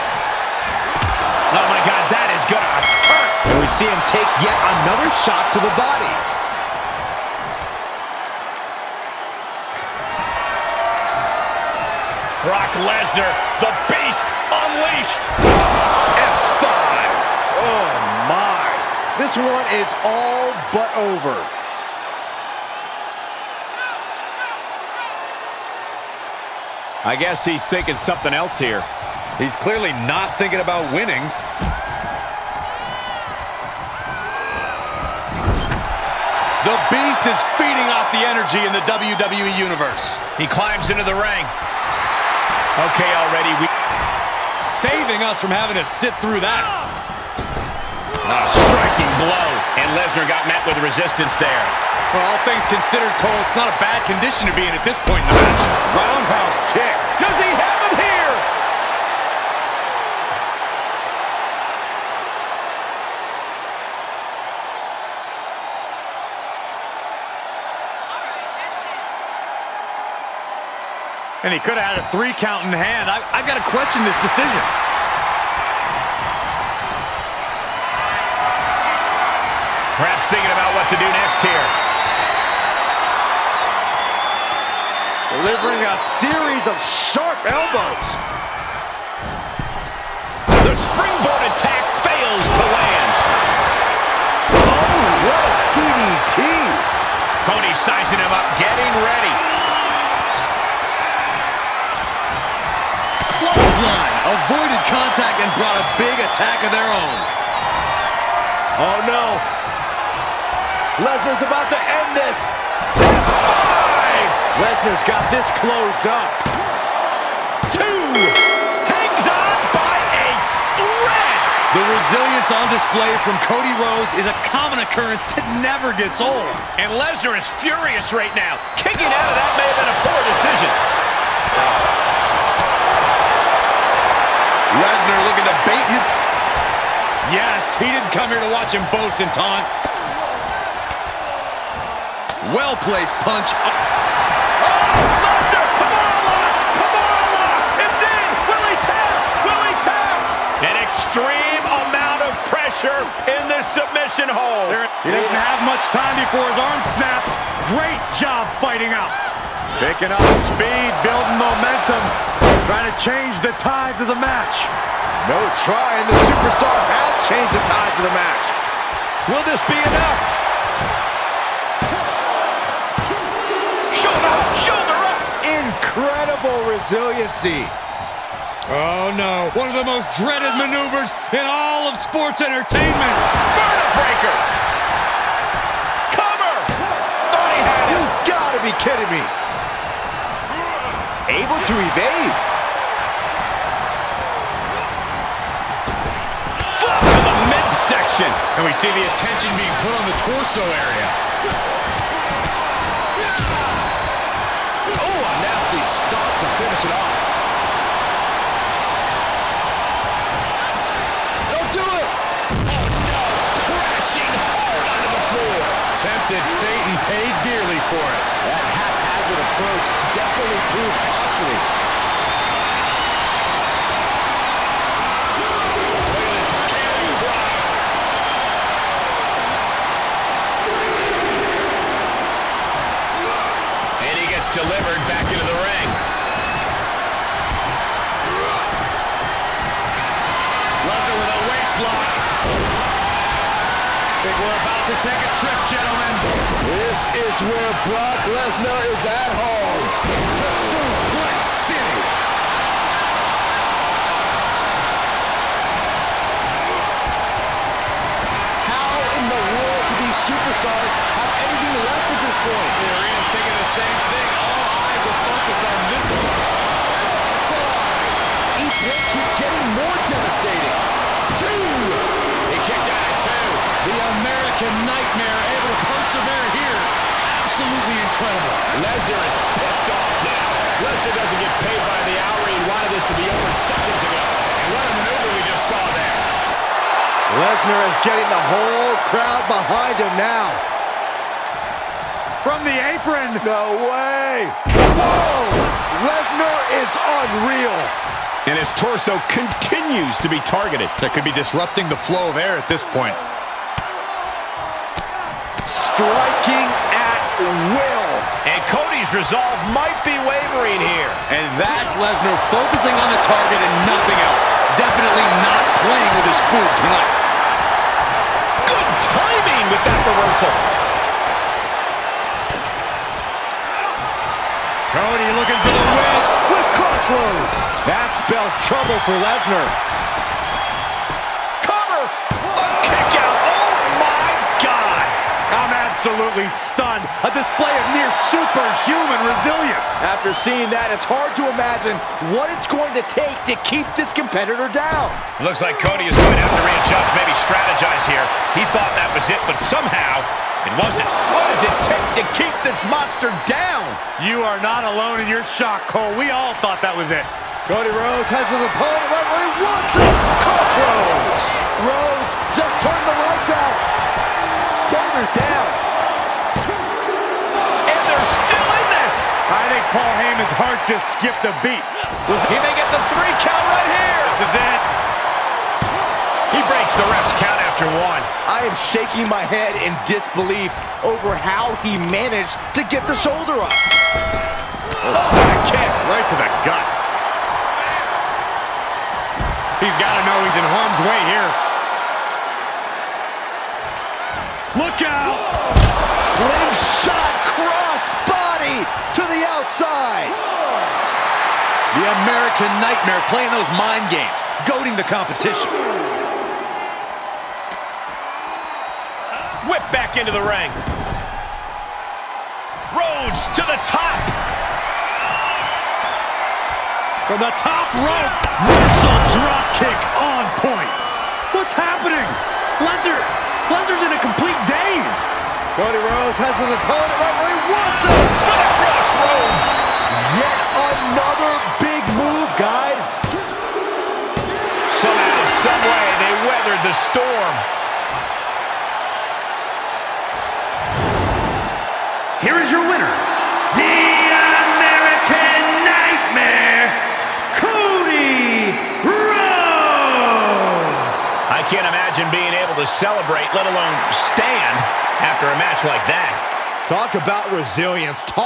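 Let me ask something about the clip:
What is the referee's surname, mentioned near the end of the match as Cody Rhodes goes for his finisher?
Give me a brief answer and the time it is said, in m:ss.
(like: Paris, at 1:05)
Watson, at 7:07.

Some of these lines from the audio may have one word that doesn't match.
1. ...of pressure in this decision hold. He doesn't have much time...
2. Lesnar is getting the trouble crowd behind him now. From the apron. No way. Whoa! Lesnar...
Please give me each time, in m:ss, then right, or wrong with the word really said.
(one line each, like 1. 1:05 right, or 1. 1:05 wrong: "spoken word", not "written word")
1. 2:32 wrong: "submission", not "decision"
2. 4:47 wrong: "whole", not "trouble".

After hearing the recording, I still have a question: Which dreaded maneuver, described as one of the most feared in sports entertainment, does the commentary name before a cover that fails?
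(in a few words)
Vertebreaker.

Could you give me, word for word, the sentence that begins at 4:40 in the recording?
Lesnar doesn't get paid by the hour.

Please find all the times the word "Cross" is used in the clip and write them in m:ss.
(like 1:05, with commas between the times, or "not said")
5:26, 7:08.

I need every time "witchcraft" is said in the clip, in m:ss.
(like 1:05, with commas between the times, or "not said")
not said.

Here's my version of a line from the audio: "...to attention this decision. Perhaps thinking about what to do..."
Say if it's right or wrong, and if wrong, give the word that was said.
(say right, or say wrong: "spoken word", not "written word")
wrong: "question", not "attention".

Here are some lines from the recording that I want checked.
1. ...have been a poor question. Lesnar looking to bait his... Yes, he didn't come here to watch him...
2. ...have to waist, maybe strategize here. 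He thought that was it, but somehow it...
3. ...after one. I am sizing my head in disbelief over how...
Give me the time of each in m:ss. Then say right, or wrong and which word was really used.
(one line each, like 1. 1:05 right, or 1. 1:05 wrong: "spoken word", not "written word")
1. 2:09 wrong: "decision", not "question"
2. 5:46 wrong: "readjust", not "waist"
3. 6:17 wrong: "shaking", not "sizing".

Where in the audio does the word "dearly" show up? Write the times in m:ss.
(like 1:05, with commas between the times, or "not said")
3:37.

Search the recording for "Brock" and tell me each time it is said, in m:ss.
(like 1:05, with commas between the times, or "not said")
0:12, 4:07.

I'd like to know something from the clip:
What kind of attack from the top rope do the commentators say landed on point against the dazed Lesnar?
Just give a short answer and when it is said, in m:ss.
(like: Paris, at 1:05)
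missile drop kick, at 6:58.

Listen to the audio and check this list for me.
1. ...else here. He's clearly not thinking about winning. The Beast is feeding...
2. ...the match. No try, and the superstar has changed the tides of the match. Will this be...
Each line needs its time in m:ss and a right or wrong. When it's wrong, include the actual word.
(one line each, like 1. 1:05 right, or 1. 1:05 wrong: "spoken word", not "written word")
1. 0:28 right
2. 2:44 right.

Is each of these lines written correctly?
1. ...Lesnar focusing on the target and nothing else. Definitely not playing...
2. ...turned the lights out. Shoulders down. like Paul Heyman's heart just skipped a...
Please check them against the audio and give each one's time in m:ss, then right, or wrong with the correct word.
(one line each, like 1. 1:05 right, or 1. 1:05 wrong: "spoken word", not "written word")
1. 5:11 right
2. 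6:02 right.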